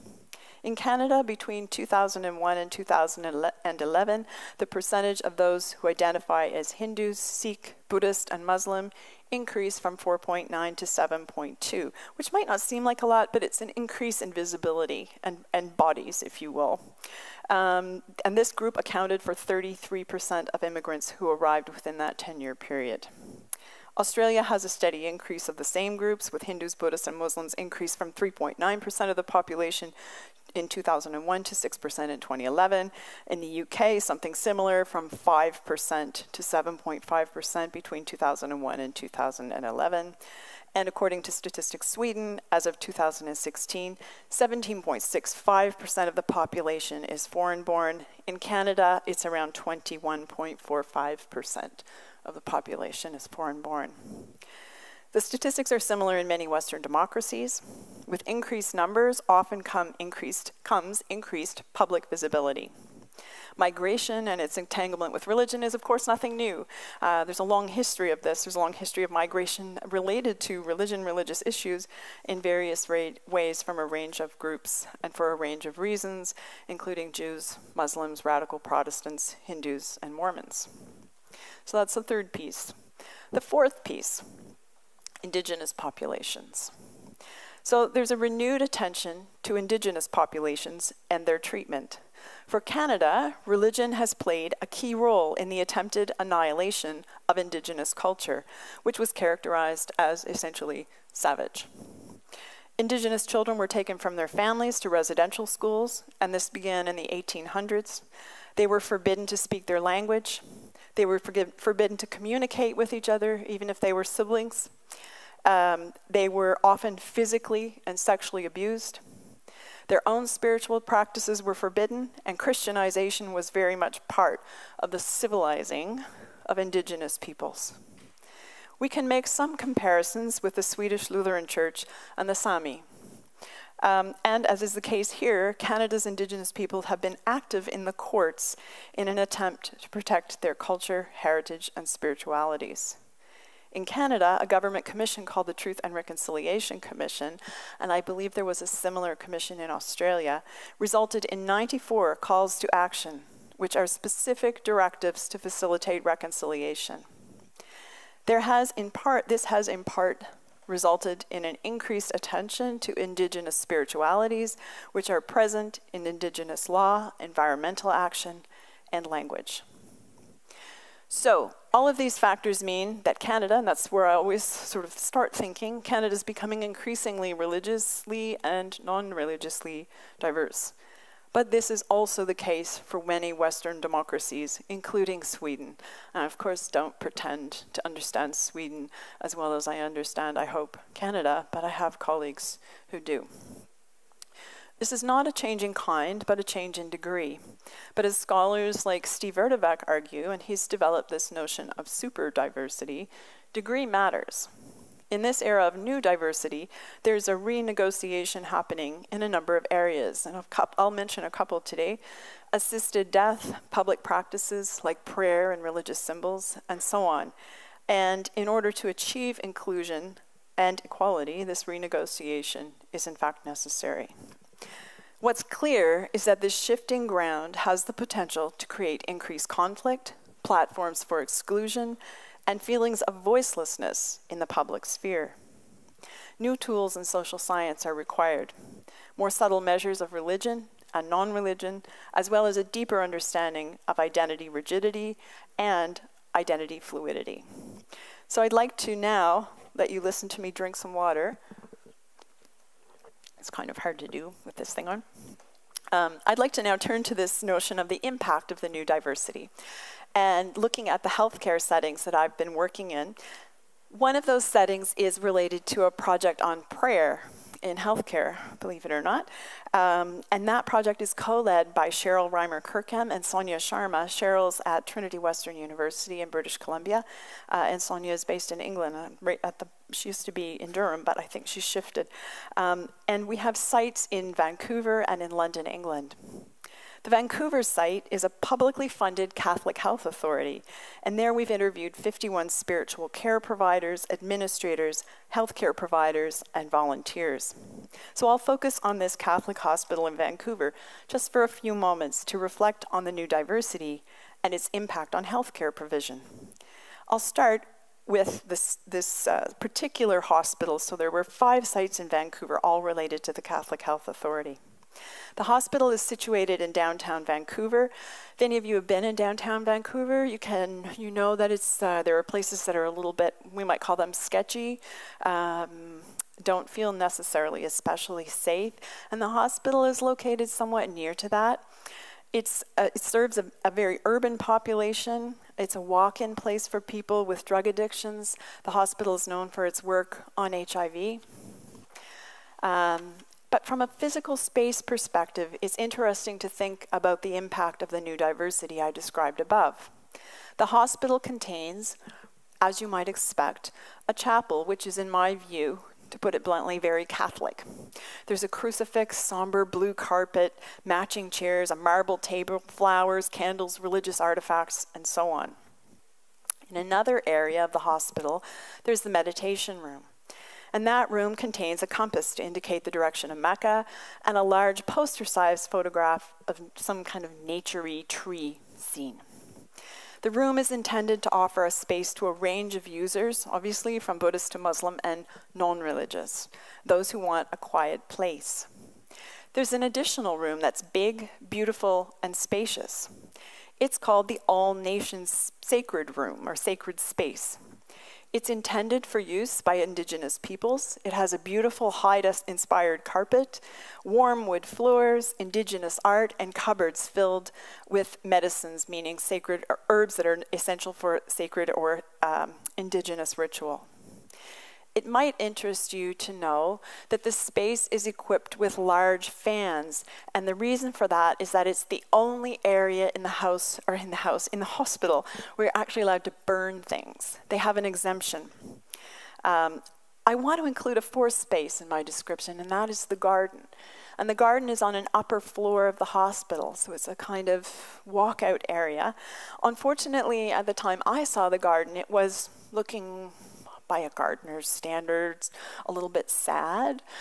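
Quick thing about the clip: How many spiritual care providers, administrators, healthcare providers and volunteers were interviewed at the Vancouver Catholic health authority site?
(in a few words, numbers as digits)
51.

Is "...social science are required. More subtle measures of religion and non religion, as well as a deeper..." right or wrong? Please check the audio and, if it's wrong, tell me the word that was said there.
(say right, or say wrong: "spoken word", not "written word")
right.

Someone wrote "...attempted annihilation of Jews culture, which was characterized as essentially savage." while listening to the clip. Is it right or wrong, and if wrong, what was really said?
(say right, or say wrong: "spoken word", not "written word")
wrong: "Indigenous", not "Jews".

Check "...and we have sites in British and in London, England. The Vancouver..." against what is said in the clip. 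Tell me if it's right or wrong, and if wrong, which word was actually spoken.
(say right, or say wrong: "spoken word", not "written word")
wrong: "Vancouver", not "British".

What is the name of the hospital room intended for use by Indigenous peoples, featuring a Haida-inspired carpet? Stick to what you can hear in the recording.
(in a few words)
All Nations Sacred Room.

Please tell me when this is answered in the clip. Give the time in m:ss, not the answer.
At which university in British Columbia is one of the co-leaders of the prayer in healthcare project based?
4:34.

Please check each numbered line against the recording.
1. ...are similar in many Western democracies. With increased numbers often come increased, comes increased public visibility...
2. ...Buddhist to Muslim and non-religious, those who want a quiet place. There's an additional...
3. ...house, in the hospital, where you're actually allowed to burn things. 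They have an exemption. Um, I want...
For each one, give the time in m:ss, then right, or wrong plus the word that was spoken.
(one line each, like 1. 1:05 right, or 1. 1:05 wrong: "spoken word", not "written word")
1. 0:55 right
2. 6:24 right
3. 7:04 right.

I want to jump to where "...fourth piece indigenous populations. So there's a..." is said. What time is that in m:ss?
1:23.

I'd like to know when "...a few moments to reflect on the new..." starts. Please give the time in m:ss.
5:01.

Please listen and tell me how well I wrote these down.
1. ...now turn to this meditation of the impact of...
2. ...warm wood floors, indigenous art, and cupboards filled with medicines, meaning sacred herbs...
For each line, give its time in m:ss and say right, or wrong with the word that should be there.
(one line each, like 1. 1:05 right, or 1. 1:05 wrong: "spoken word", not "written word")
1. 4:16 wrong: "notion", not "meditation"
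2. 6:44 right.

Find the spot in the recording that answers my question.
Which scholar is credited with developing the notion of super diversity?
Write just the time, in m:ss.
3:19.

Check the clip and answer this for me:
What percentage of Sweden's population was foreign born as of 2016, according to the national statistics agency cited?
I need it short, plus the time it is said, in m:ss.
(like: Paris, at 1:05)
17.65%, at 0:44.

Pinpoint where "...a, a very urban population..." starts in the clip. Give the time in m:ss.
5:33.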